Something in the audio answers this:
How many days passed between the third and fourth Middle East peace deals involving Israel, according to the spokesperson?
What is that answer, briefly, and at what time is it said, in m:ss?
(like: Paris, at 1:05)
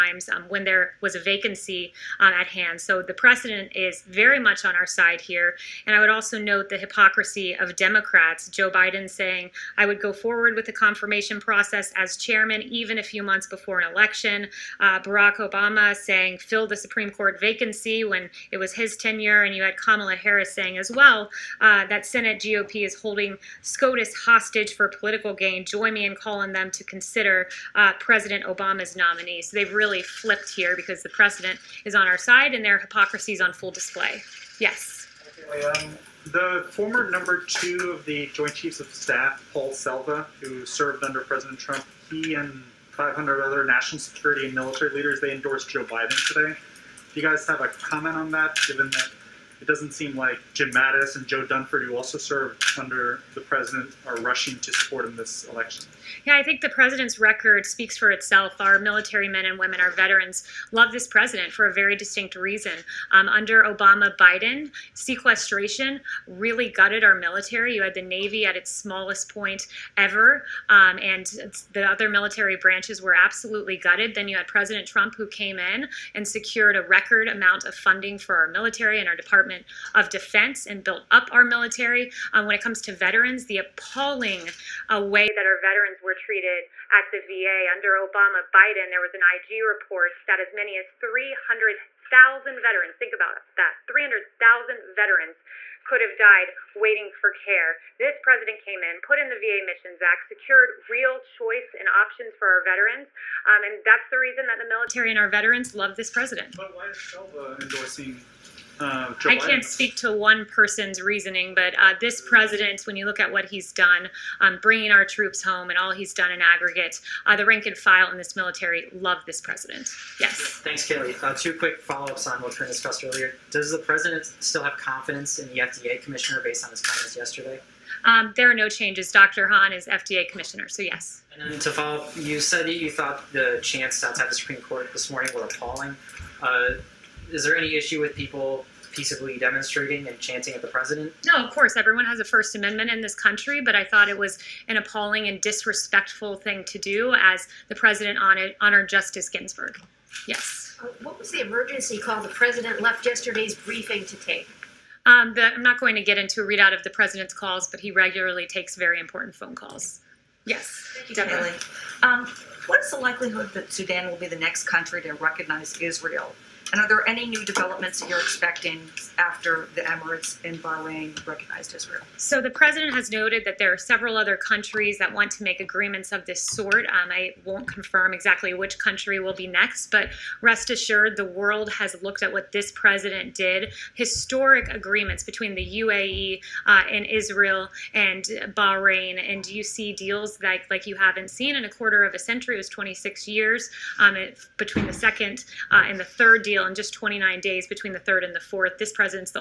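29, at 3:16.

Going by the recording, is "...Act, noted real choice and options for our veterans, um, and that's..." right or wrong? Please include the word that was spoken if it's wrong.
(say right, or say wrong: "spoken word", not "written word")
wrong: "secured", not "noted".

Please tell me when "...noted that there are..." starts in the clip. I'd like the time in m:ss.
2:53.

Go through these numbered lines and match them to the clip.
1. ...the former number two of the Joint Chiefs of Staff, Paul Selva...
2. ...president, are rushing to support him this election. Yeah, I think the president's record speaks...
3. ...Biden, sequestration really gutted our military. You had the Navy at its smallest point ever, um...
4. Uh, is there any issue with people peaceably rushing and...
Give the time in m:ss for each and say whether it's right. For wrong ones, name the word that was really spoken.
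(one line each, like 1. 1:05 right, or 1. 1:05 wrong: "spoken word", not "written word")
1. 0:36 right
2. 0:53 right
3. 1:04 right
4. 2:16 wrong: "demonstrating", not "rushing".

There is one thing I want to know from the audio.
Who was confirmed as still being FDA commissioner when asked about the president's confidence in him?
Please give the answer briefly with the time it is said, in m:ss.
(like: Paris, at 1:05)
Dr. Hahn, at 2:09.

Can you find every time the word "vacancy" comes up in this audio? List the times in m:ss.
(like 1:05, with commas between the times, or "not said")
0:01, 0:17.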